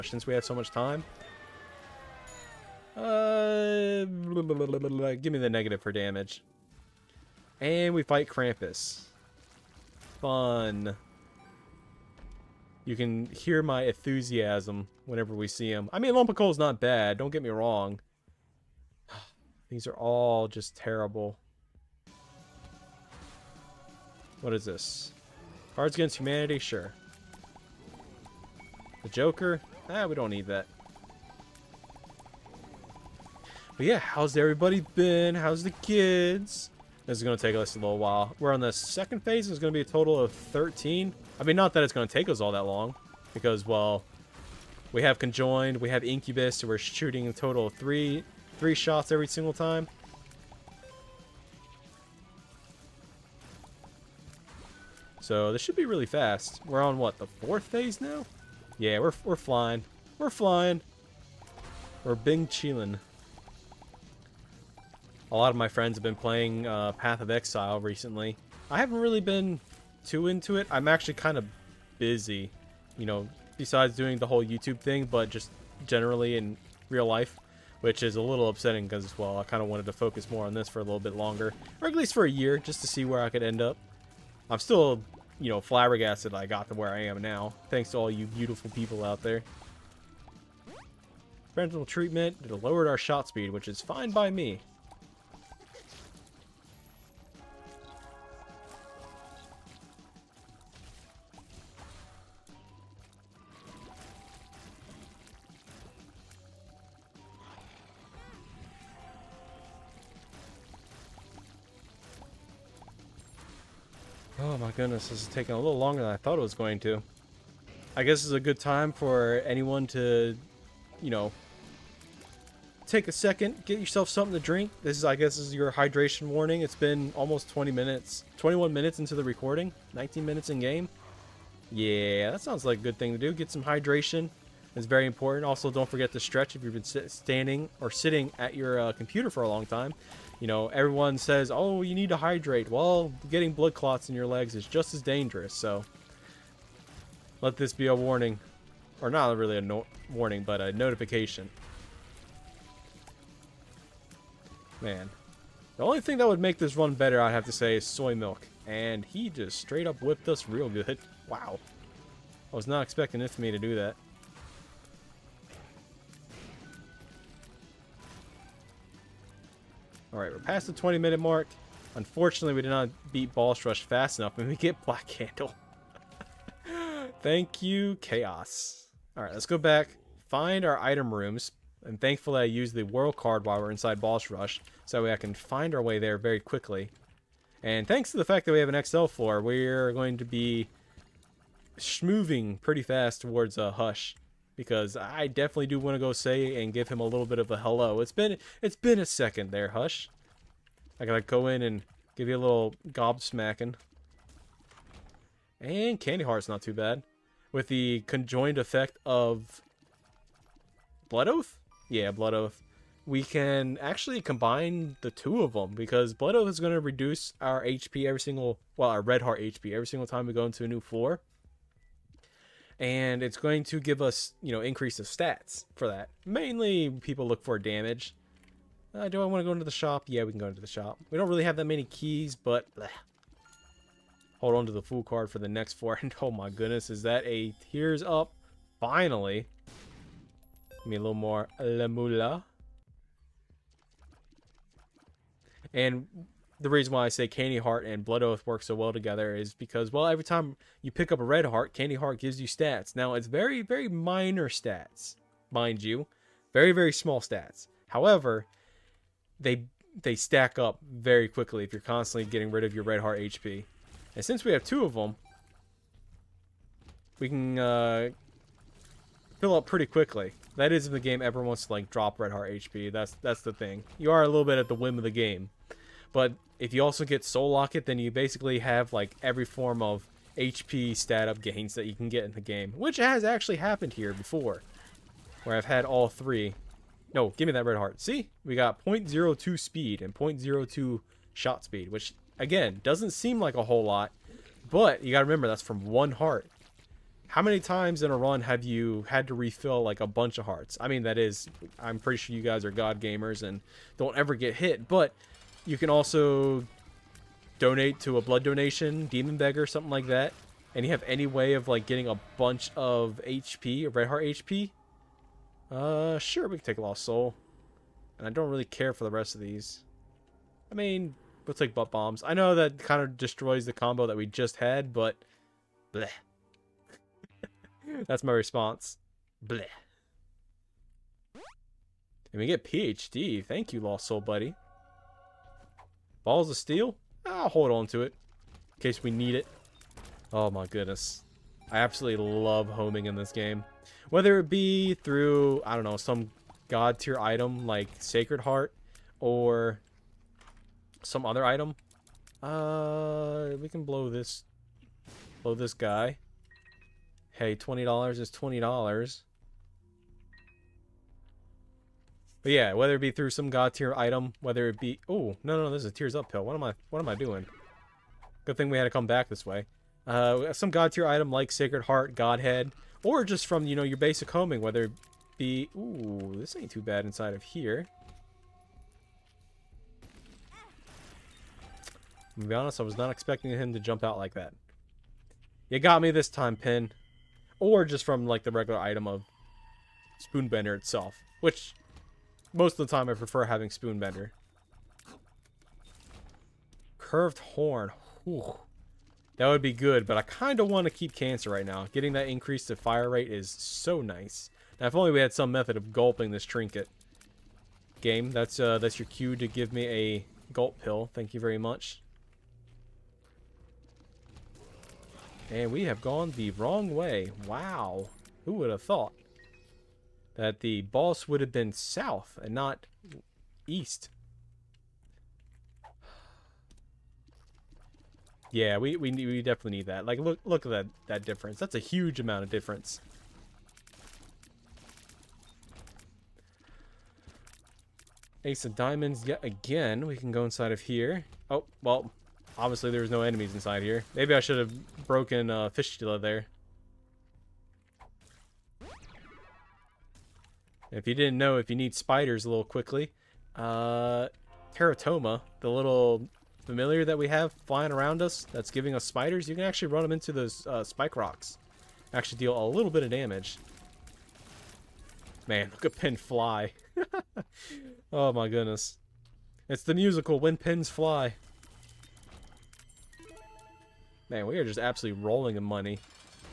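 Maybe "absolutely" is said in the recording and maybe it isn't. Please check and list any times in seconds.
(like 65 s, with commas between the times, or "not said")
341 s, 474 s.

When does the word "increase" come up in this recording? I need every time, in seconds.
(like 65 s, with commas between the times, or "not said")
224 s, 402 s.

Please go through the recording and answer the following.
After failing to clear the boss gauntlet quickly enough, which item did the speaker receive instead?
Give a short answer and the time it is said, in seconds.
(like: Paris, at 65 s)
Black Candle, at 174 s.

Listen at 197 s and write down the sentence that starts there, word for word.
It's been it's been a second there, Hush.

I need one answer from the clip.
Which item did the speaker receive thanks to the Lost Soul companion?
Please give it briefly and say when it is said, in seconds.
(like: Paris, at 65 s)
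PhD, at 332 s.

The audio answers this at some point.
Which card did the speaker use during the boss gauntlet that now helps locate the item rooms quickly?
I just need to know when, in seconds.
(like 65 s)
182 s.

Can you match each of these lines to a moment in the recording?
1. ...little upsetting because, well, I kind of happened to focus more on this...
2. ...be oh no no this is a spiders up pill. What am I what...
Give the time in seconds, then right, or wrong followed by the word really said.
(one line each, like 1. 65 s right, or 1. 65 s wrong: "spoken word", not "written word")
1. 78 s wrong: "wanted", not "happened"
2. 364 s wrong: "tears", not "spiders".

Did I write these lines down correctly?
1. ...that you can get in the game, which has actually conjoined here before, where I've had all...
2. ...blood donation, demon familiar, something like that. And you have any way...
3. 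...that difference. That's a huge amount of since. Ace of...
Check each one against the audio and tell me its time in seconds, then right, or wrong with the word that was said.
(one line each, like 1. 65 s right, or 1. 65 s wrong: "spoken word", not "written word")
1. 281 s wrong: "happened", not "conjoined"
2. 308 s wrong: "beggar", not "familiar"
3. 431 s wrong: "difference", not "since".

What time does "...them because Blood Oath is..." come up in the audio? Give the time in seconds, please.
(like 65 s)
215 s.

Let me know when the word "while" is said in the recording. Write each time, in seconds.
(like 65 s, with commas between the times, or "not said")
37 s, 183 s.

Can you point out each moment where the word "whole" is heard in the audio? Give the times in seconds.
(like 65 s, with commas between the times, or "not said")
74 s, 293 s.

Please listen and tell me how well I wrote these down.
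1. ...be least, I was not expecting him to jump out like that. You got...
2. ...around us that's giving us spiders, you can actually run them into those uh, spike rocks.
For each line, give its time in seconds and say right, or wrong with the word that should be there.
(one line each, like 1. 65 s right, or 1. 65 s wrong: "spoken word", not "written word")
1. 382 s wrong: "honest", not "least"
2. 457 s right.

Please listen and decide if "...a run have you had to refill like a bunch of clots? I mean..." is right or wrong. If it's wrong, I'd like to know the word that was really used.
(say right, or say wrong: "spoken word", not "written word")
wrong: "hearts", not "clots".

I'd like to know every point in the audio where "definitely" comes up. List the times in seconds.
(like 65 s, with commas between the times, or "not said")
195 s, 429 s.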